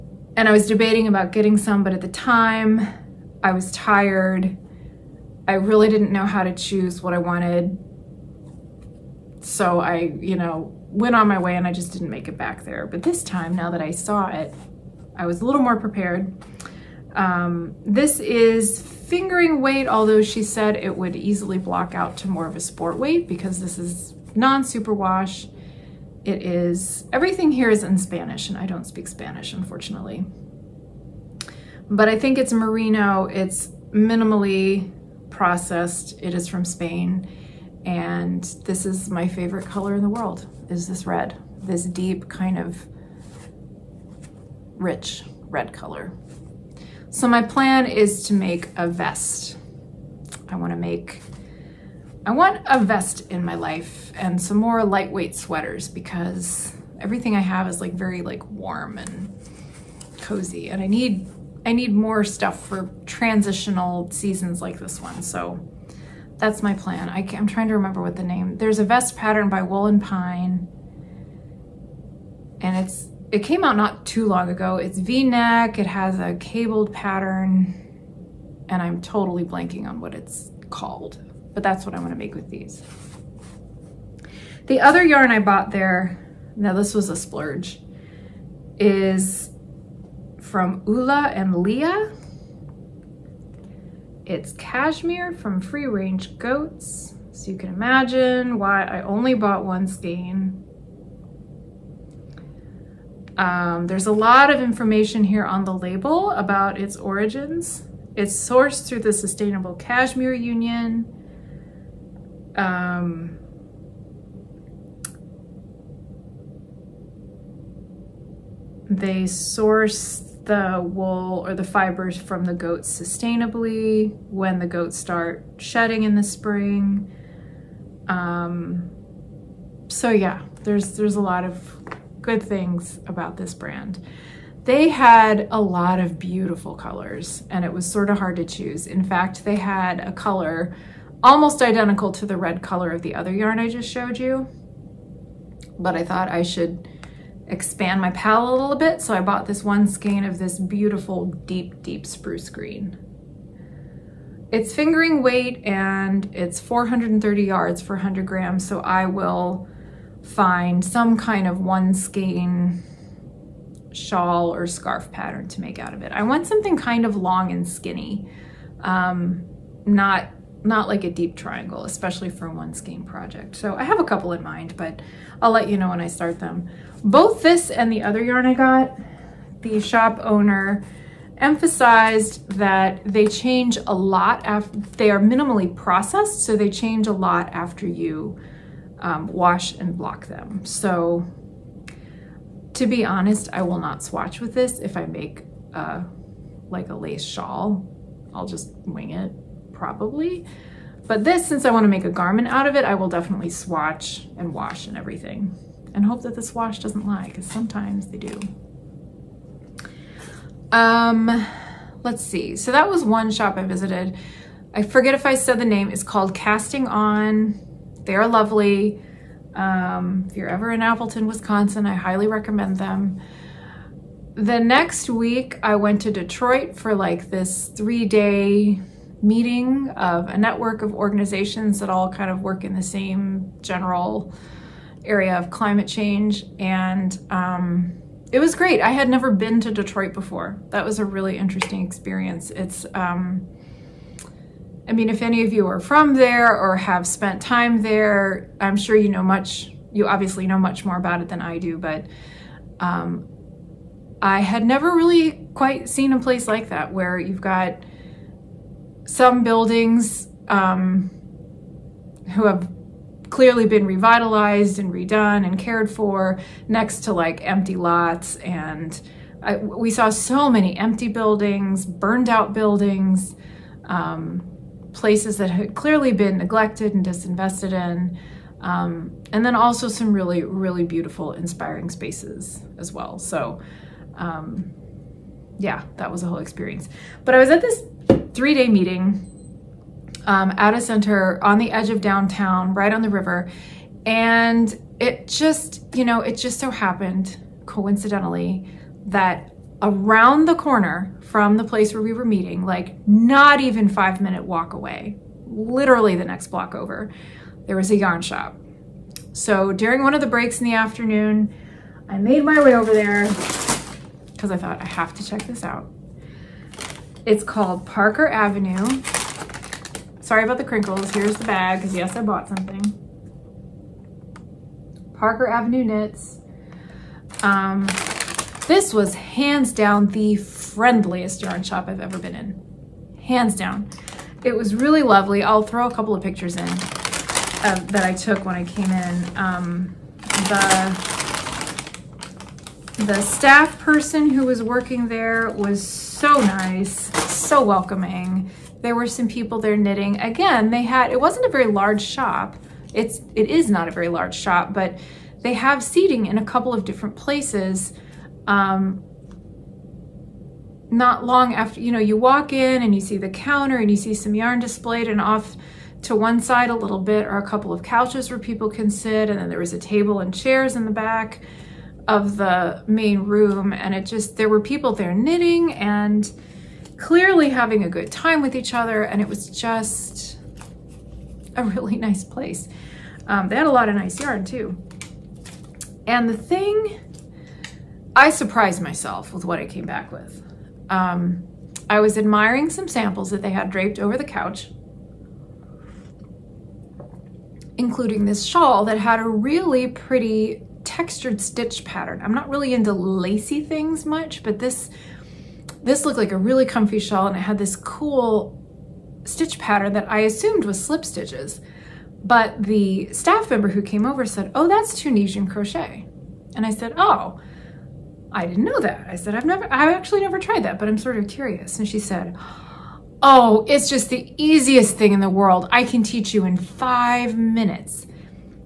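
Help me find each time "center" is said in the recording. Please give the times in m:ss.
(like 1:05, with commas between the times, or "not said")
4:50.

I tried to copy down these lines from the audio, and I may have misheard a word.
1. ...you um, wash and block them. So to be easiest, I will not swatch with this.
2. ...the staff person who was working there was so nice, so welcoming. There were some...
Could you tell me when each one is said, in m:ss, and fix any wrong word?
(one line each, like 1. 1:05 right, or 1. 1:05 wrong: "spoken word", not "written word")
1. 3:07 wrong: "honest", not "easiest"
2. 5:43 right.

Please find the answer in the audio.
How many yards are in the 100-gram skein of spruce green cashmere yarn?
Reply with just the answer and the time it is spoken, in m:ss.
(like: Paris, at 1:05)
430, at 2:36.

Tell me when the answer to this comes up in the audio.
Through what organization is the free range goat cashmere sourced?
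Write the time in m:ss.
1:49.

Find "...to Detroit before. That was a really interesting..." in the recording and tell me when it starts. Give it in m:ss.
3:59.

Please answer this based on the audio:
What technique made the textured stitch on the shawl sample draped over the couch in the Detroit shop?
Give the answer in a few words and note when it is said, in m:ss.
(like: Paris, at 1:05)
Tunisian crochet, at 6:54.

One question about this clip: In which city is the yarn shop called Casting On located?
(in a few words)
Appleton, Wisconsin.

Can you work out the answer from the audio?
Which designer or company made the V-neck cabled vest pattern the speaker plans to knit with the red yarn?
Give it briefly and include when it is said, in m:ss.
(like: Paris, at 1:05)
Wool and Pine, at 1:09.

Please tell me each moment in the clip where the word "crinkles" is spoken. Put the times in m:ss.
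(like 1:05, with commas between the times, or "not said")
5:20.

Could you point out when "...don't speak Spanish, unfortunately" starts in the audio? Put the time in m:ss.
0:28.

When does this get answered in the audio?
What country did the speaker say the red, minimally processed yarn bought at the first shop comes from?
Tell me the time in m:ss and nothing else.
0:36.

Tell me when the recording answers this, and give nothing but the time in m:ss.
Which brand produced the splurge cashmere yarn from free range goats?
1:30.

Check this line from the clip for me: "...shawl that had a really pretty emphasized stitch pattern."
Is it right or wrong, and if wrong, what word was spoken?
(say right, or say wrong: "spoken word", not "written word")
wrong: "textured", not "emphasized".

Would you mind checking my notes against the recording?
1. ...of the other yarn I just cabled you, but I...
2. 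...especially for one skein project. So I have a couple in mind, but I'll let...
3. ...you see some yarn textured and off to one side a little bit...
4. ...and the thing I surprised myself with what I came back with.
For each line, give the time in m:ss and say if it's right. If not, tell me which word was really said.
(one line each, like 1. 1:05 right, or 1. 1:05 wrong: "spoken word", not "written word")
1. 2:22 wrong: "showed", not "cabled"
2. 2:51 right
3. 6:03 wrong: "displayed", not "textured"
4. 6:26 right.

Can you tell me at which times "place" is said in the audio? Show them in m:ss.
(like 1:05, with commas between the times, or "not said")
4:16, 4:34, 5:01, 5:57, 6:22.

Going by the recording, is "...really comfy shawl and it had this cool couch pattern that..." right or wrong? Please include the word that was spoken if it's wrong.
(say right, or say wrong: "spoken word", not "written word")
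wrong: "stitch", not "couch".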